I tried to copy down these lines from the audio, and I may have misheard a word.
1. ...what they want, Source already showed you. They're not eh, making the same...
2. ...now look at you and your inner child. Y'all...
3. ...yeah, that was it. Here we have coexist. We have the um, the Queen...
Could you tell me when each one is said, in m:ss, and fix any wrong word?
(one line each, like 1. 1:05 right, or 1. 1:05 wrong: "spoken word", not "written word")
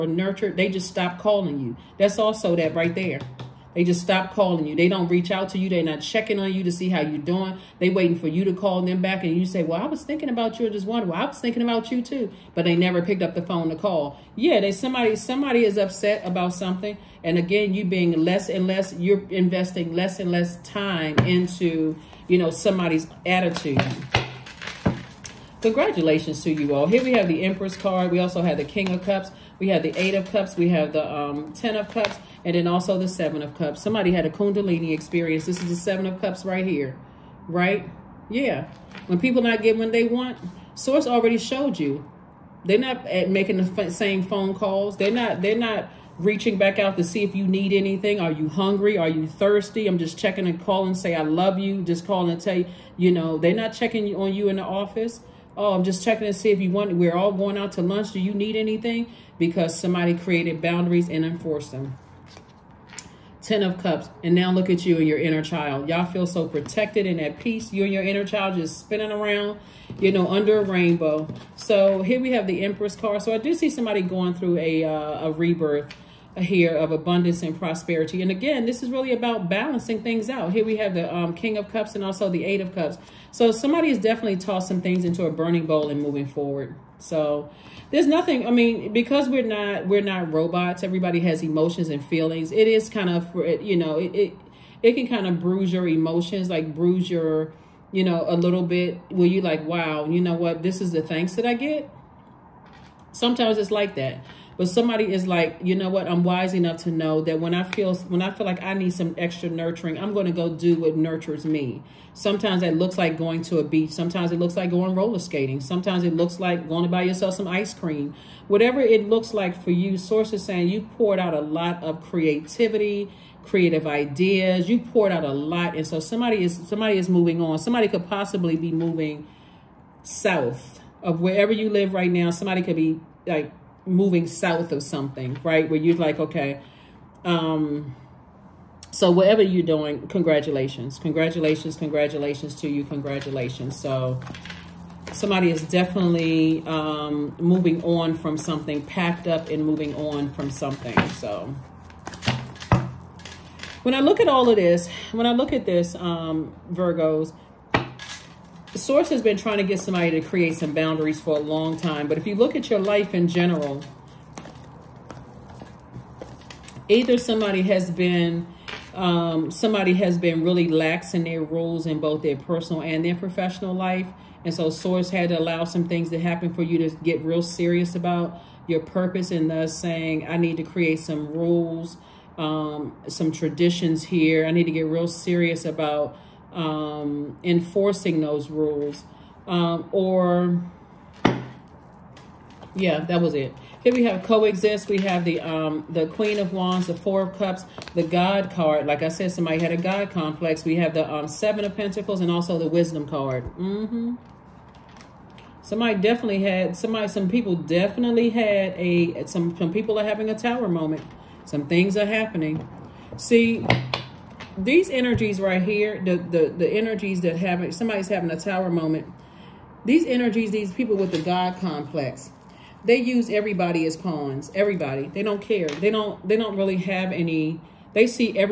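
1. 0:39 right
2. 1:04 right
3. 3:12 right.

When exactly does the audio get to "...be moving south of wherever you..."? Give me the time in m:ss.
2:08.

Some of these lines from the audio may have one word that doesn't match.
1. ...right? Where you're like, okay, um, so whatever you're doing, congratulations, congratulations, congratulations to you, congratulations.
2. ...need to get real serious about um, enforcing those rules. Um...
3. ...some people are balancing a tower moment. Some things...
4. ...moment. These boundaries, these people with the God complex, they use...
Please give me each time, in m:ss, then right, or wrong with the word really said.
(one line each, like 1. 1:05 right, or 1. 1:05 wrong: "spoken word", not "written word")
1. 2:15 right
2. 3:04 right
3. 3:29 wrong: "having", not "balancing"
4. 3:38 wrong: "energies", not "boundaries".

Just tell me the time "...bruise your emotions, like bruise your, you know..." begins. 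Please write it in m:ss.
1:35.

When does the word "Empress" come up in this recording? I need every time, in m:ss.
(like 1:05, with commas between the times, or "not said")
0:27, 1:12.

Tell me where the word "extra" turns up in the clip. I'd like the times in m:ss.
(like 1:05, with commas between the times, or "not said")
1:49.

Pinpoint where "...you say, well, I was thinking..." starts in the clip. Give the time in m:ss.
0:09.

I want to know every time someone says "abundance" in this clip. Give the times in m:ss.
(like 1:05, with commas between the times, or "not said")
1:16.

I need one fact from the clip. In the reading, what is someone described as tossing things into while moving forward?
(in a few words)
a burning bowl.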